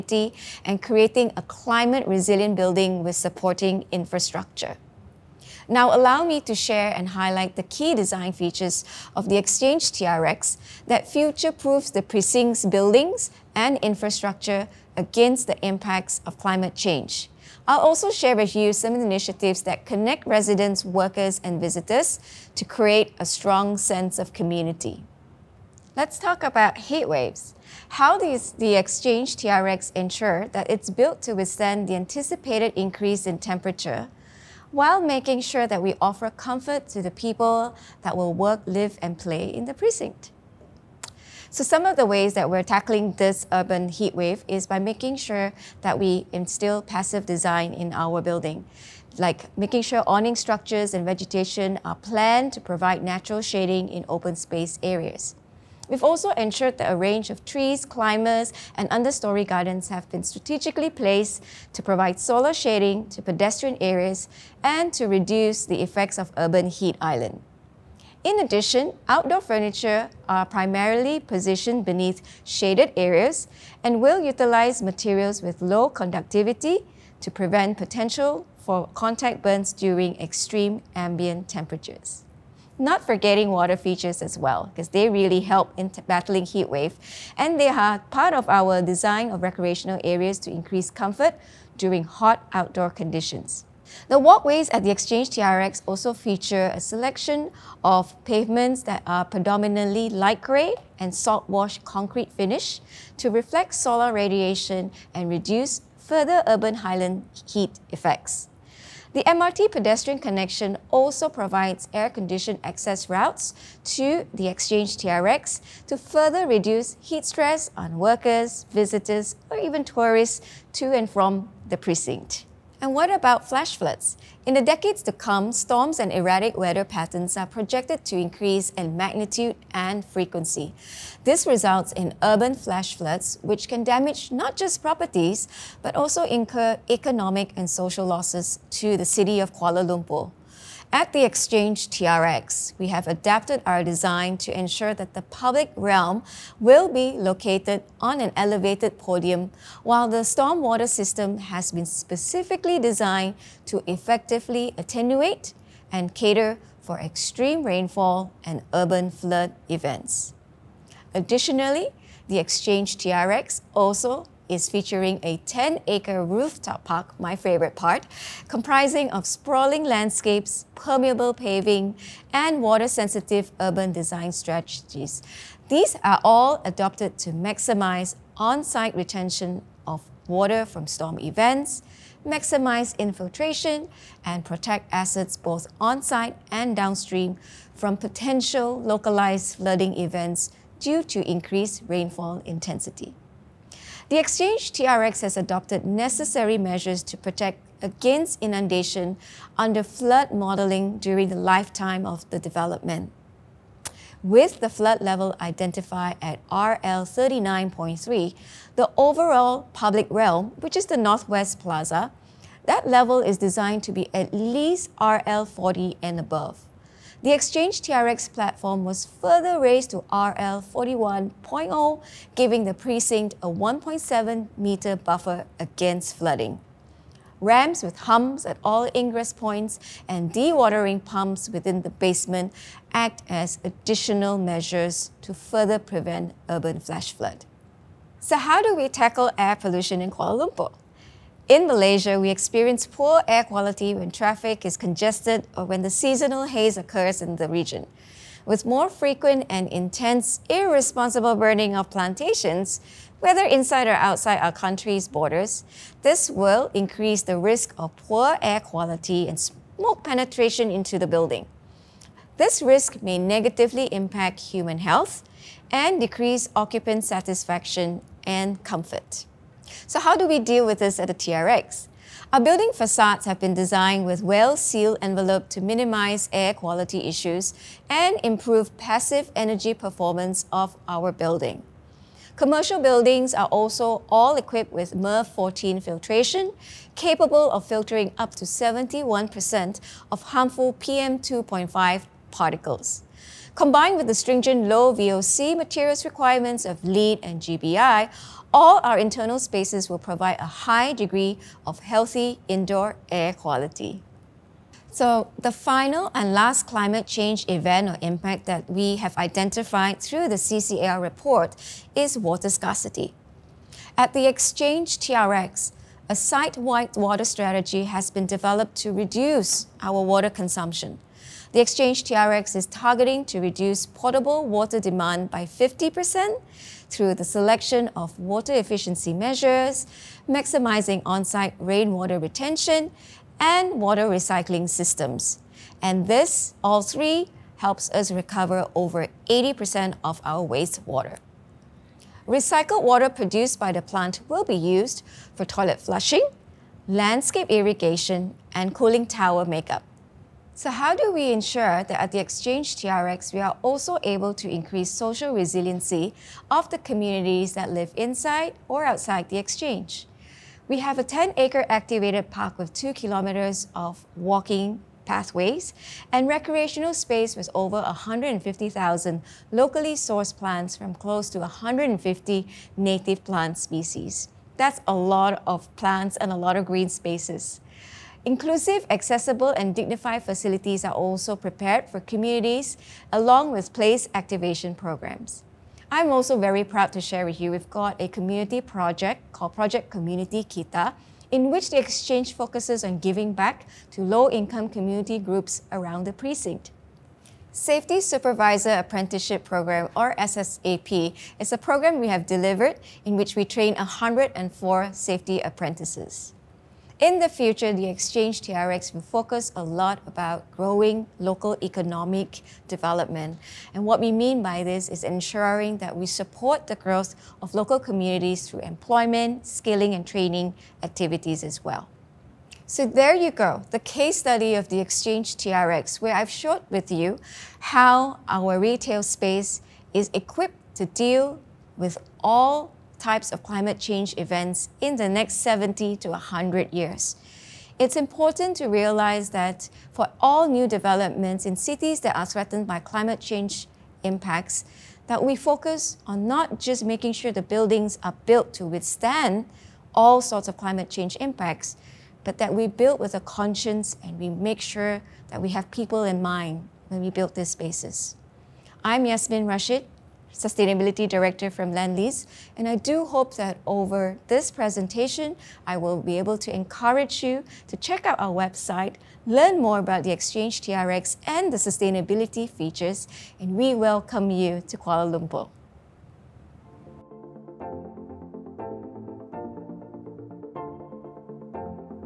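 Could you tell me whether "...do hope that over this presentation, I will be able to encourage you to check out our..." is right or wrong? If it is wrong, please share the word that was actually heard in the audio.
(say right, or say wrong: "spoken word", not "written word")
right.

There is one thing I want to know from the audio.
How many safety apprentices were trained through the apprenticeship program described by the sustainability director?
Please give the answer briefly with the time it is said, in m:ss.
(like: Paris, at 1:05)
104, at 6:43.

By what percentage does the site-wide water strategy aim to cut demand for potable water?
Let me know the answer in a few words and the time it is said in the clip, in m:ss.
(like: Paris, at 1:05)
50%, at 5:25.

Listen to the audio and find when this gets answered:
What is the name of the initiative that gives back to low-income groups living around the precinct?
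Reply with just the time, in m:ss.
6:29.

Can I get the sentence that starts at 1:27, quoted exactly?
And they are part of our design of recreational areas to increase comfort during hot outdoor conditions.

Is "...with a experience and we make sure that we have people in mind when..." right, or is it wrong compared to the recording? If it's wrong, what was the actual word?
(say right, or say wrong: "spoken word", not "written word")
wrong: "conscience", not "experience".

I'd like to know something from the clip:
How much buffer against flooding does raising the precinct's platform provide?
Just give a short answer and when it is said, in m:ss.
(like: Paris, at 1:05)
1.7 meters, at 3:43.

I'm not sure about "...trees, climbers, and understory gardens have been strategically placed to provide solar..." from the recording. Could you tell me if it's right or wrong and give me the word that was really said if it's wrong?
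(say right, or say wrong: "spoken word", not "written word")
right.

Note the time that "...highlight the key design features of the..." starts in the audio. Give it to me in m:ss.
0:07.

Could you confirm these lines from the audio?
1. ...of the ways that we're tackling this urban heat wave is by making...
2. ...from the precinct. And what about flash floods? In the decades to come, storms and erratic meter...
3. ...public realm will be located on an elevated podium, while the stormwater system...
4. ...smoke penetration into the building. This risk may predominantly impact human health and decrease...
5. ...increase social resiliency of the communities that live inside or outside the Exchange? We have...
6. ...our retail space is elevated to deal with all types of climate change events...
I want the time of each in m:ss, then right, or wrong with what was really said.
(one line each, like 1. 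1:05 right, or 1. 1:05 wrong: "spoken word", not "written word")
1. 0:41 right
2. 2:01 wrong: "weather", not "meter"
3. 2:25 right
4. 4:19 wrong: "negatively", not "predominantly"
5. 5:54 right
6. 7:08 wrong: "equipped", not "elevated".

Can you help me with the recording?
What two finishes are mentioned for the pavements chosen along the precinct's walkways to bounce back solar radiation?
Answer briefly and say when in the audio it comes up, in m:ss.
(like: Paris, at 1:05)
Light grey and salt wash concrete, at 1:40.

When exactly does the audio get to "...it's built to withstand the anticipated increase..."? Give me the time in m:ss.
0:30.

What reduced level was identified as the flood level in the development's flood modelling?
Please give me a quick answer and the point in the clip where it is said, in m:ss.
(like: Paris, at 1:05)
RL 39.3, at 3:26.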